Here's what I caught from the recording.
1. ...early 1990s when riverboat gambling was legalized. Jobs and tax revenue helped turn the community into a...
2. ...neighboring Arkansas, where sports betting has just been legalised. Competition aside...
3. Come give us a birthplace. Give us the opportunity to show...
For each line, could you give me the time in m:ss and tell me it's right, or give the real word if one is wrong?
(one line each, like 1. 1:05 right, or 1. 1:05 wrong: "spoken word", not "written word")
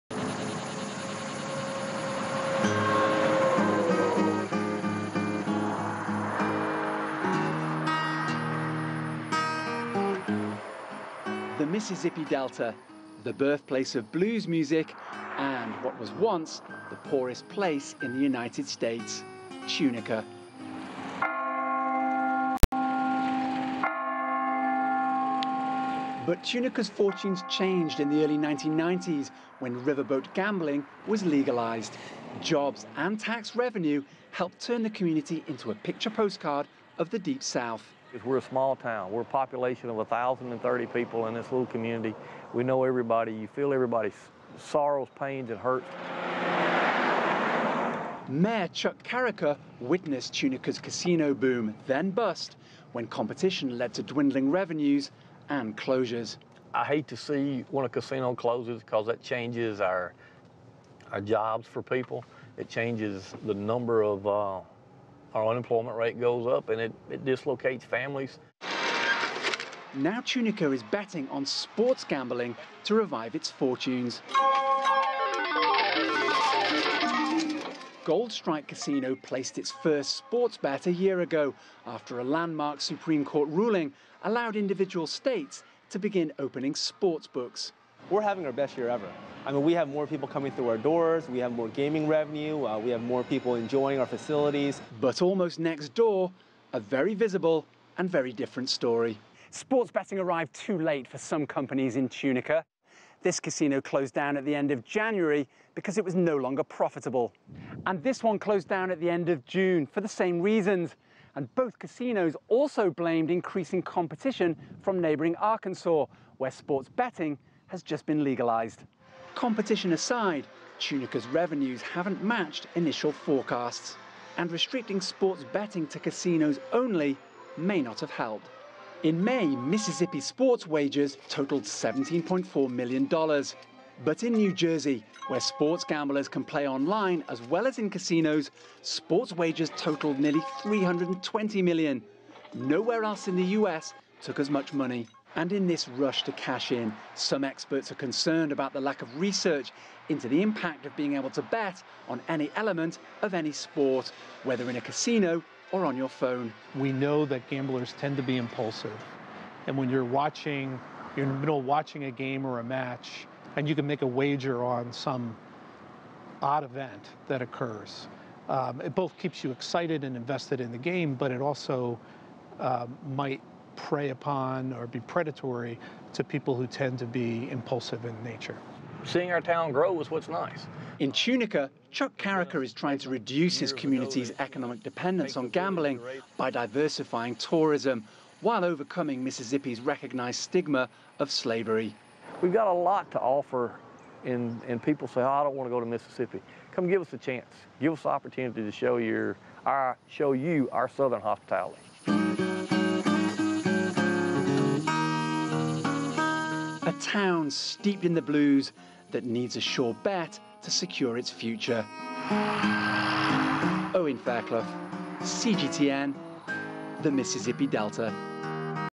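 1. 0:28 right
2. 1:54 right
3. 3:16 wrong: "chance", not "birthplace".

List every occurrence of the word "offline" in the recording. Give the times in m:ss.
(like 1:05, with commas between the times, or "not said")
not said.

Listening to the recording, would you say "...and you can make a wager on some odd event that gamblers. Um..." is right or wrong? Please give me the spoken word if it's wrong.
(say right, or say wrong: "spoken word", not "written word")
wrong: "occurs", not "gamblers".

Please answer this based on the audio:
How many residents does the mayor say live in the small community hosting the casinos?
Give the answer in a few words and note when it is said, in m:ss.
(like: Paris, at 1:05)
1,030, at 0:39.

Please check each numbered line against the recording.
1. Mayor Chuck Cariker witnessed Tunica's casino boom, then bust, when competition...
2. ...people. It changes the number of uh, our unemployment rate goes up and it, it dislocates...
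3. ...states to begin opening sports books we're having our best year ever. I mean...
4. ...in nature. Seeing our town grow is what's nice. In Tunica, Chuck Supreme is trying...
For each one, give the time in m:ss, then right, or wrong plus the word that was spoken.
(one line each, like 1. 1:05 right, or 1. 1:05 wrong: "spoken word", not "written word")
1. 0:48 right
2. 1:01 right
3. 1:25 right
4. 2:58 wrong: "Cariker", not "Supreme".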